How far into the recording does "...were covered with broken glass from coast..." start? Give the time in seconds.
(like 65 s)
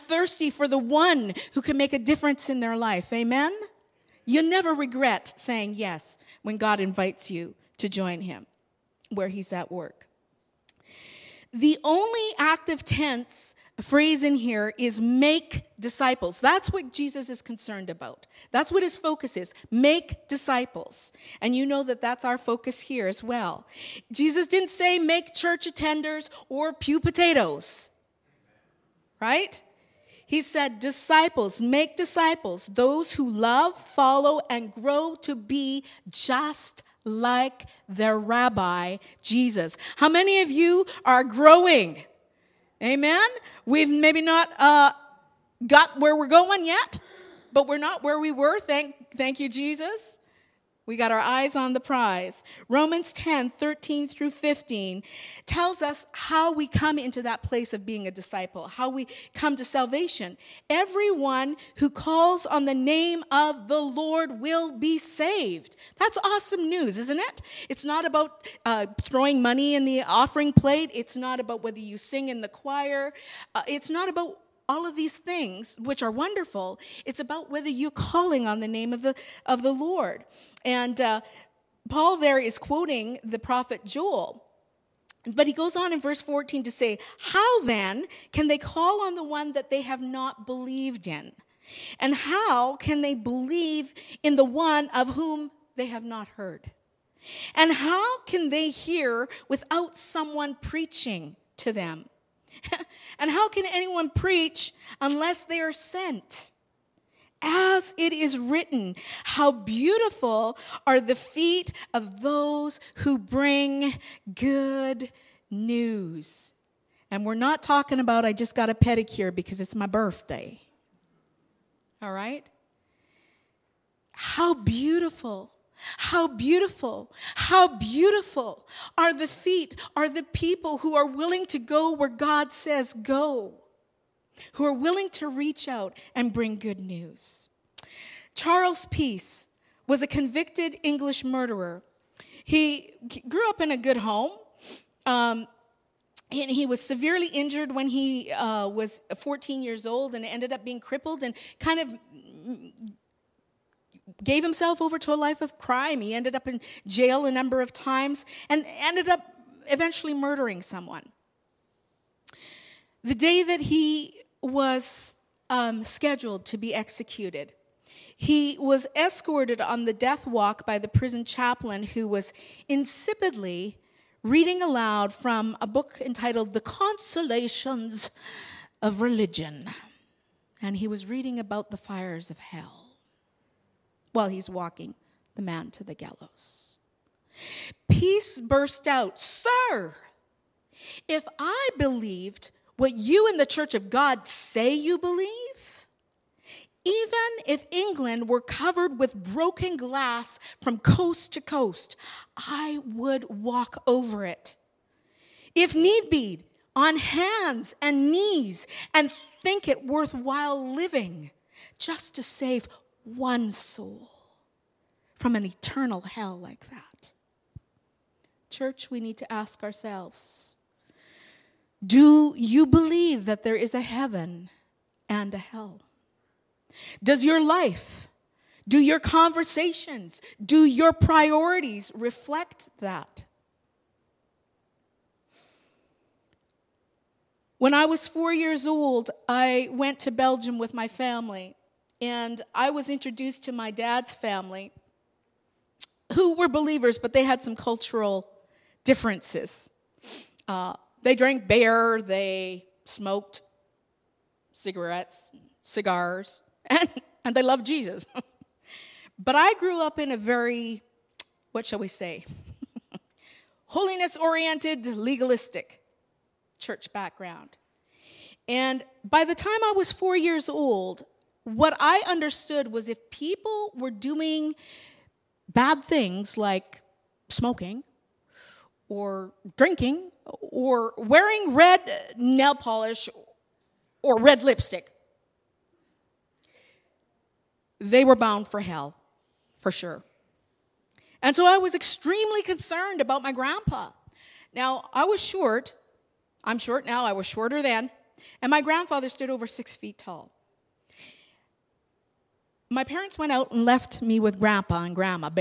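198 s.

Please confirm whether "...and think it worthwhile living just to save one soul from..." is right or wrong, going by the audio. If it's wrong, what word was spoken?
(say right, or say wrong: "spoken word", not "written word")
right.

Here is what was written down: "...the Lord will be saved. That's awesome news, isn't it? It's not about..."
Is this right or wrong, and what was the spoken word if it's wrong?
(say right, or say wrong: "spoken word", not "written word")
right.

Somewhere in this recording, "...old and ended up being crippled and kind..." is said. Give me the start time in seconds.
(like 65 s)
149 s.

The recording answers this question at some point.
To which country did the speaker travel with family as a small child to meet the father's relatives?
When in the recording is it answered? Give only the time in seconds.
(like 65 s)
240 s.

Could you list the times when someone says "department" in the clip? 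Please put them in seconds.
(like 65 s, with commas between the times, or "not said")
not said.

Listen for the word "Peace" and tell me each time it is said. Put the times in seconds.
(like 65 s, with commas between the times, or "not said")
138 s, 187 s.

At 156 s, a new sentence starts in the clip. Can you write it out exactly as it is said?
He ended up in jail a number of times and ended up eventually murdering someone.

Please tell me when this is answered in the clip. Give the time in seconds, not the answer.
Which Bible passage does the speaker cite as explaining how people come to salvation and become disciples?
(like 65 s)
52 s.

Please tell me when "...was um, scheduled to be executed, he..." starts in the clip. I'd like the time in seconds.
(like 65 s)
164 s.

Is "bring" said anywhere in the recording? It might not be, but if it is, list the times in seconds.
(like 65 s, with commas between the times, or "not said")
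113 s, 136 s.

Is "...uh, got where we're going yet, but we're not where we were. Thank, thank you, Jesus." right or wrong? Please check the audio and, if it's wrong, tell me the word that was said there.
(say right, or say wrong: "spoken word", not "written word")
right.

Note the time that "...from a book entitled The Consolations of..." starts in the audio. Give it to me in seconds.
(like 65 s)
175 s.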